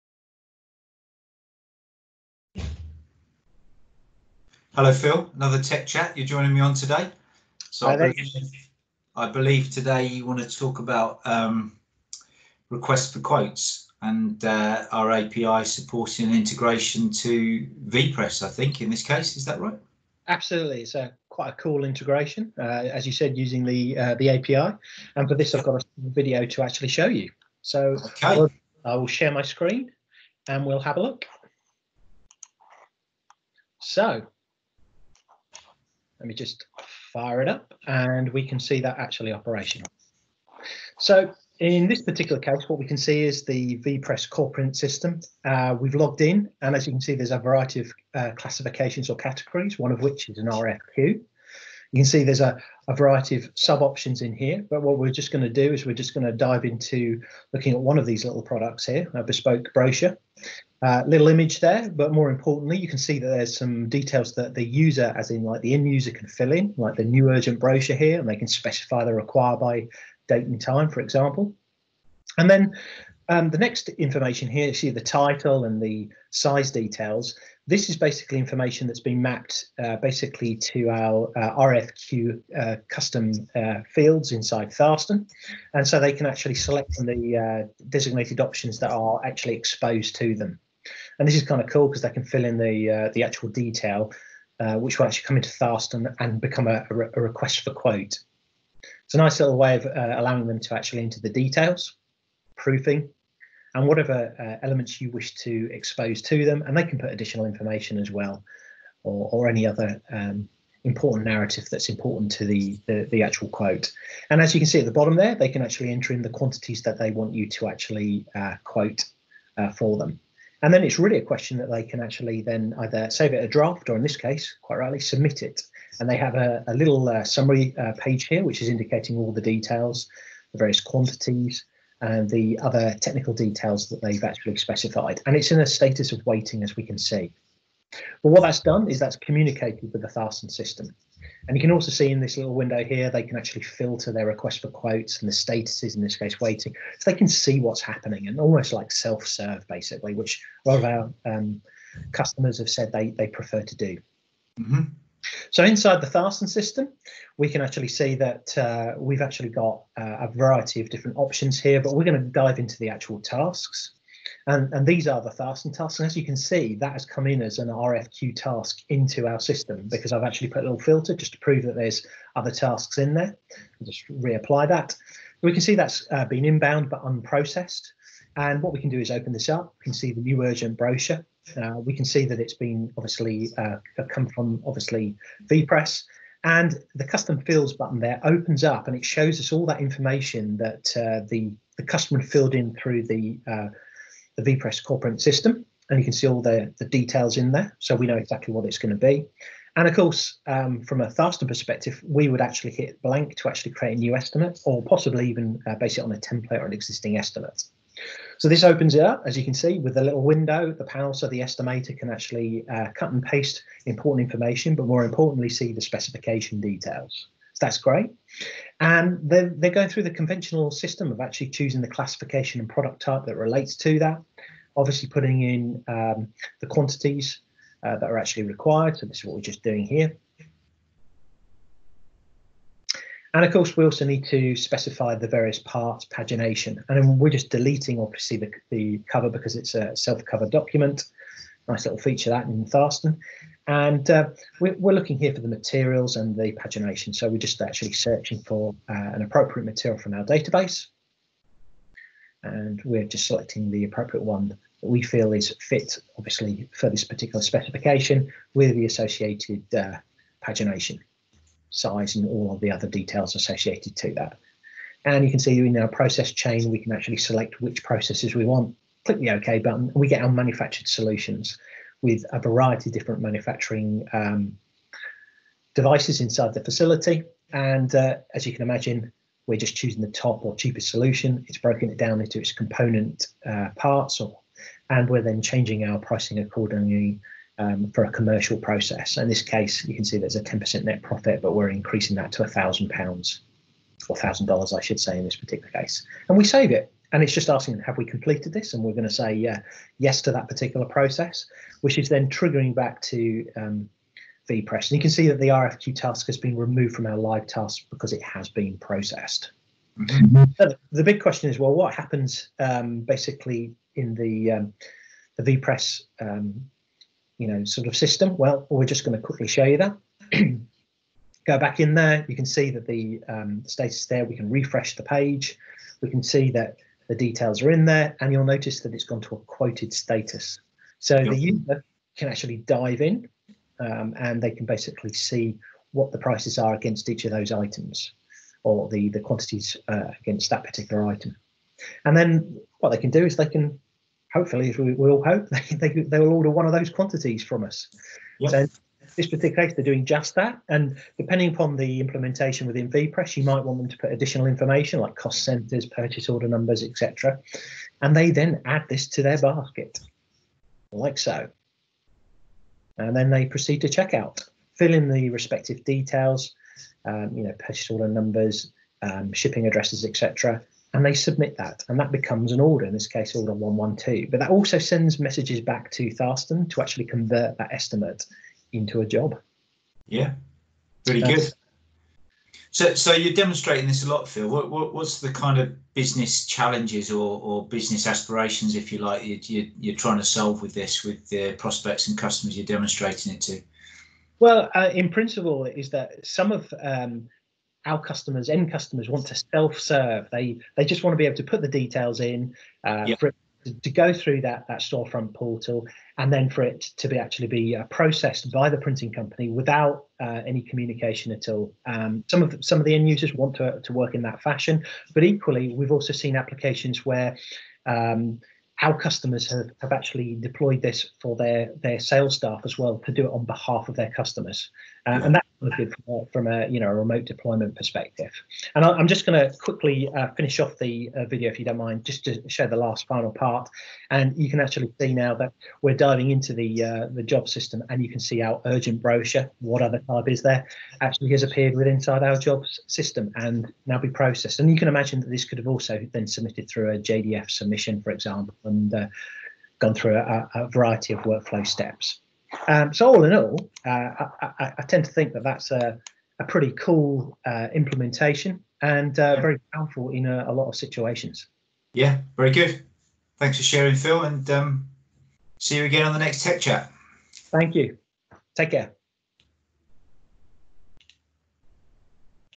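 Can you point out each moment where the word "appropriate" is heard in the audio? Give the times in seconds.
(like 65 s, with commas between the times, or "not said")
249 s, 253 s.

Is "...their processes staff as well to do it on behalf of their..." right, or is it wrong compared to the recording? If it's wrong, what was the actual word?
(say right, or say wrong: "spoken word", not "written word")
wrong: "sales", not "processes".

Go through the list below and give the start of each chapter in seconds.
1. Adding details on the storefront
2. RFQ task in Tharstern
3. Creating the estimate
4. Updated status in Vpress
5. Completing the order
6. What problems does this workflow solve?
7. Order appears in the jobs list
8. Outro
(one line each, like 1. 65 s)
1. 34 s
2. 154 s
3. 207 s
4. 309 s
5. 338 s
6. 380 s
7. 433 s
8. 463 s.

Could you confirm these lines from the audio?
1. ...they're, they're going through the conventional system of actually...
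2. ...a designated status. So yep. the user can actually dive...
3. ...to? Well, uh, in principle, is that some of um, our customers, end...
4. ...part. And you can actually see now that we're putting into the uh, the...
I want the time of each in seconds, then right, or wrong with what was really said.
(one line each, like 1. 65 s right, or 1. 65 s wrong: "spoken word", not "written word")
1. 219 s right
2. 329 s wrong: "quoted", not "designated"
3. 393 s right
4. 433 s wrong: "diving", not "putting".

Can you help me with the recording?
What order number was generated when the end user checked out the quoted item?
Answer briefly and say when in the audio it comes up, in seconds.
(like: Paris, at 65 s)
112, at 373 s.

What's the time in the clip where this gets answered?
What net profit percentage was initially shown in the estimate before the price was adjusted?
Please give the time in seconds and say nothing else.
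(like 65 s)
290 s.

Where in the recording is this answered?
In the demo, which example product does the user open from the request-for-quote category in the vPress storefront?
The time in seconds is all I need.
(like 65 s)
59 s.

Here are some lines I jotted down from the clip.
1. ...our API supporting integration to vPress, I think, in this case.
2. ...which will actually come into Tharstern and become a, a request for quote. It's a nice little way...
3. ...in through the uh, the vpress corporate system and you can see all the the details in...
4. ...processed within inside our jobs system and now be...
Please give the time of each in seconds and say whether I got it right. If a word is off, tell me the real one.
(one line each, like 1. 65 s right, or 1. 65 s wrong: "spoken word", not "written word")
1. 14 s right
2. 94 s right
3. 192 s right
4. 441 s wrong: "appeared", not "processed".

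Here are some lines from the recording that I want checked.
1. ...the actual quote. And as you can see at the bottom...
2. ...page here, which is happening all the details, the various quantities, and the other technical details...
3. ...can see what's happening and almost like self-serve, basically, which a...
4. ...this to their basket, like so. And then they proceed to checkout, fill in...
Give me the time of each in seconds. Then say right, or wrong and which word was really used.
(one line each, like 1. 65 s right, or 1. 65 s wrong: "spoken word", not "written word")
1. 113 s right
2. 127 s wrong: "indicating", not "happening"
3. 147 s right
4. 358 s right.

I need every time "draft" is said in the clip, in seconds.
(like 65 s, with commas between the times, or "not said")
123 s.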